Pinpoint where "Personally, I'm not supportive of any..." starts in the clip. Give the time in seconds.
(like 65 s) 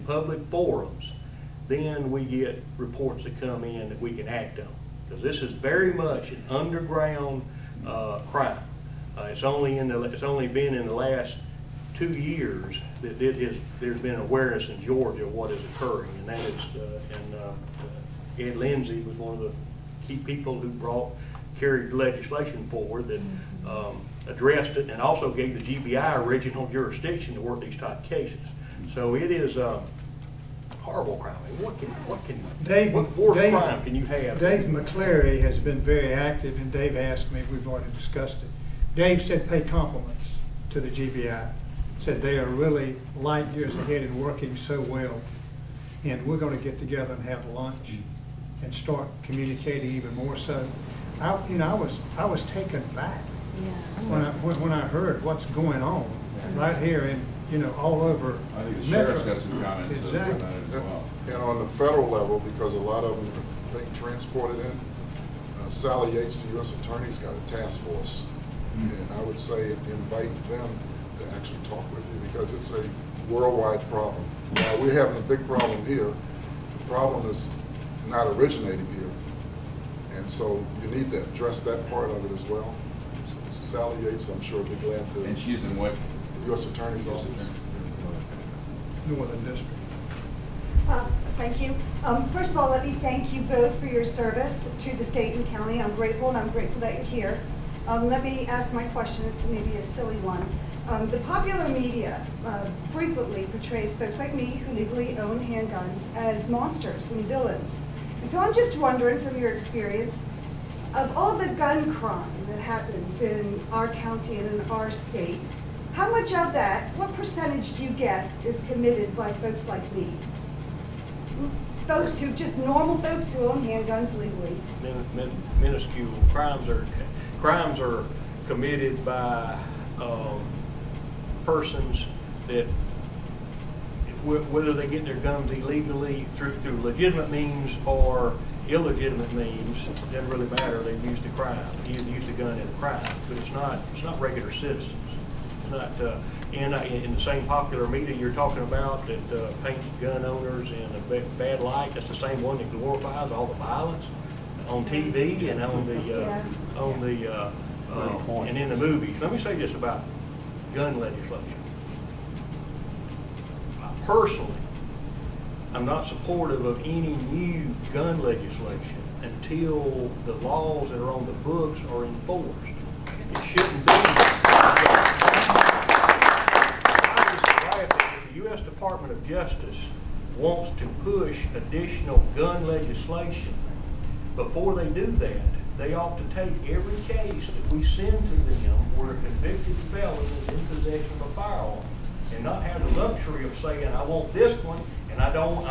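164 s.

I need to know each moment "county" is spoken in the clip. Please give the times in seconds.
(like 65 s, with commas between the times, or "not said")
95 s, 113 s.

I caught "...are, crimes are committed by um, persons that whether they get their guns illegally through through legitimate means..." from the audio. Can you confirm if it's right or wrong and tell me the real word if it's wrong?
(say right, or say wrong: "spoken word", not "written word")
right.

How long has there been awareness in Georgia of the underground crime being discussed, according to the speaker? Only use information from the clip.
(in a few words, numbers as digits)
2 years.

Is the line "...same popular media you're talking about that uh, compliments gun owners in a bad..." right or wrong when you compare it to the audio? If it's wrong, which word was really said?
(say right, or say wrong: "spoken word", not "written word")
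wrong: "paints", not "compliments".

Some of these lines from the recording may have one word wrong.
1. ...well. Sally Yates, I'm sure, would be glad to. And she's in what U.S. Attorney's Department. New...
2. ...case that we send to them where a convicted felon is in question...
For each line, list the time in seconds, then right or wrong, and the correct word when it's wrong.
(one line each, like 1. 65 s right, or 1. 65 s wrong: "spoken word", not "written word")
1. 82 s wrong: "Office", not "Department"
2. 187 s wrong: "possession", not "question".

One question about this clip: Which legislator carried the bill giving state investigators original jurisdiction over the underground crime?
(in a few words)
Ed Lindsay.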